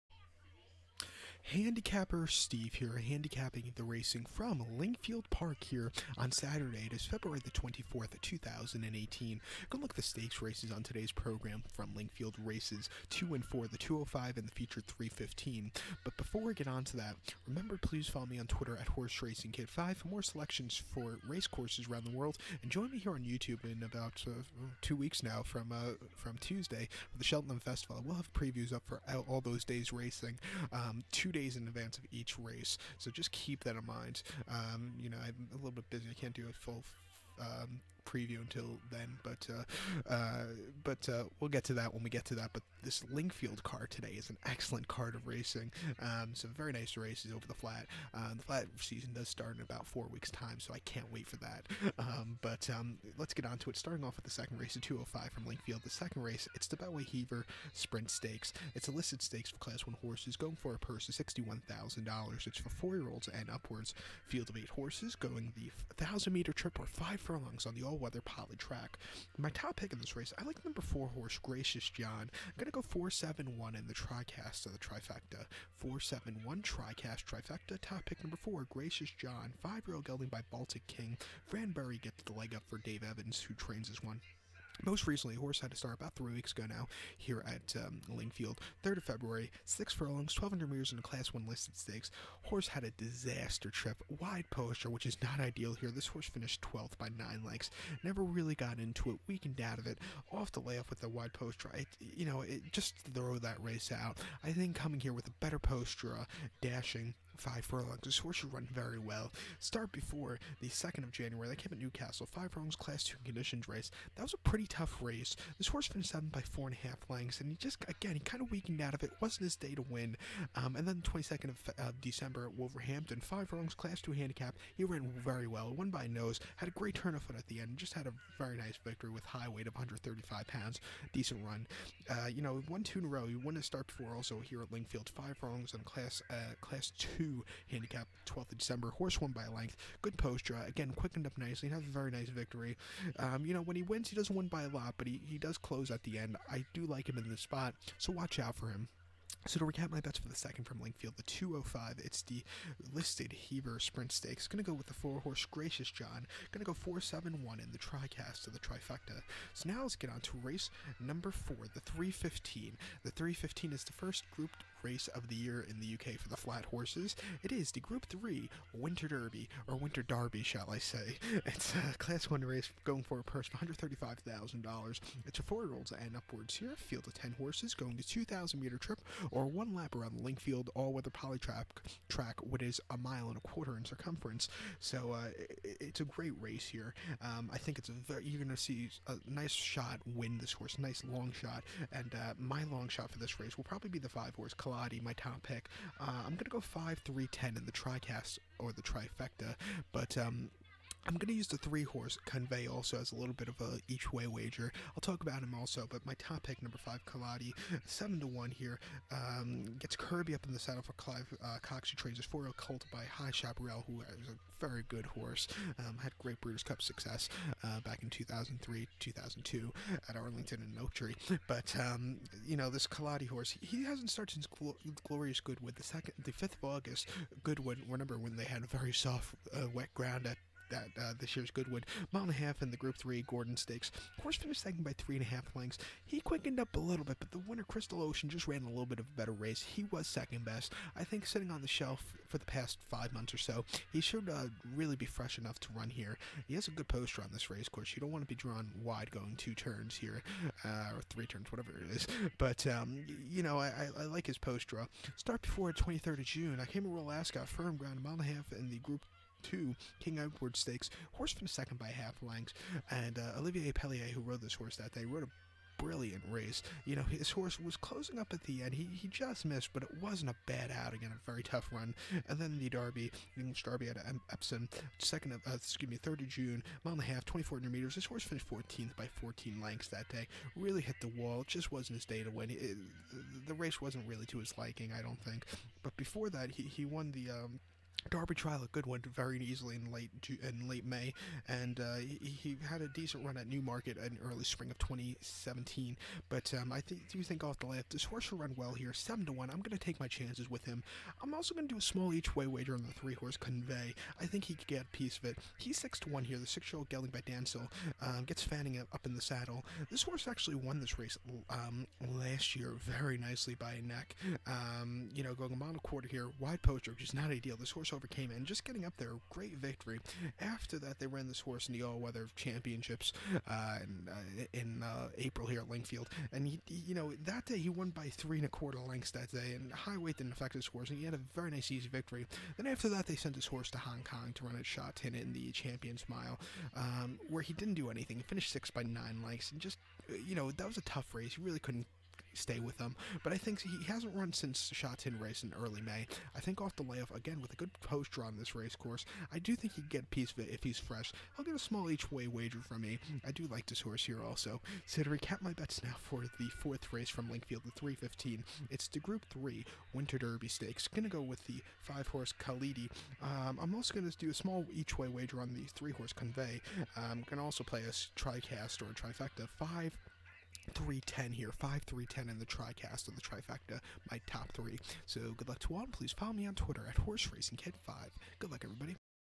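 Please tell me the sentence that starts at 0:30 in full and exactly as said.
Um, two two days in advance of each race.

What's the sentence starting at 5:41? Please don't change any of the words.
He really couldn't stay with him.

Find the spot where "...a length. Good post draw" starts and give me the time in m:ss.
2:19.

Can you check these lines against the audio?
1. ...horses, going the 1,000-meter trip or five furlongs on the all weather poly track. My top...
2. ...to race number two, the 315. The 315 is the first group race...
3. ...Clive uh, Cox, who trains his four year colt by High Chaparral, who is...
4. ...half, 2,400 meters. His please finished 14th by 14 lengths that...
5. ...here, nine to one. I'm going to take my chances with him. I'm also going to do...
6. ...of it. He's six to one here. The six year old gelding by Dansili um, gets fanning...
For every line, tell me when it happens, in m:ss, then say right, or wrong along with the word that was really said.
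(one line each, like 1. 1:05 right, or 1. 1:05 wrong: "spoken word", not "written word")
1. 1:04 right
2. 2:40 wrong: "four", not "two"
3. 3:30 right
4. 4:37 wrong: "horse", not "please"
5. 4:58 wrong: "seven", not "nine"
6. 5:05 right.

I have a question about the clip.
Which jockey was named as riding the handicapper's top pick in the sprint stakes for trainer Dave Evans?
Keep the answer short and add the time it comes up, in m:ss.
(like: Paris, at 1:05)
Fran Berry, at 1:21.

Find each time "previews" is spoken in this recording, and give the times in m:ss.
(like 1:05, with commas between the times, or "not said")
0:28, 0:38.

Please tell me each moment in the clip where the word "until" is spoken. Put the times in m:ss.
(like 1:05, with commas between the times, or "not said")
0:38.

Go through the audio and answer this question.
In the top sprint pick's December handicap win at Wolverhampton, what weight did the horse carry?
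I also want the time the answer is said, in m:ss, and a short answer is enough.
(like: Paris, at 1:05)
135 pounds, at 2:09.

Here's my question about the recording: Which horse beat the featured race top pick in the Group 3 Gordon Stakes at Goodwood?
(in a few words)
Crystal Ocean.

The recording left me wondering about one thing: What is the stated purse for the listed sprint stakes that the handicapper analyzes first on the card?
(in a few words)
$61,000.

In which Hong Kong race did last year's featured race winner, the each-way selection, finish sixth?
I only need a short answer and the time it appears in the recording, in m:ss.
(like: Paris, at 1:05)
Champions Mile, at 5:35.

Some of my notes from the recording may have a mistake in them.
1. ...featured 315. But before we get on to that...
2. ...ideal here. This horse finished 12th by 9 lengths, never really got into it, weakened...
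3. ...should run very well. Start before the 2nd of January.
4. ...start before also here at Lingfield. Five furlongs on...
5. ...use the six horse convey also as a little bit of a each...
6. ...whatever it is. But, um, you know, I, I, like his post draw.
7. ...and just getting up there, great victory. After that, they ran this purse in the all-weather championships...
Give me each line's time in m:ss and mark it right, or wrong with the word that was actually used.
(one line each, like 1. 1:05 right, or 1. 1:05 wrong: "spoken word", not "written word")
1. 0:14 right
2. 1:35 right
3. 1:48 right
4. 2:13 right
5. 3:21 wrong: "three", not "six"
6. 4:11 right
7. 5:18 wrong: "horse", not "purse".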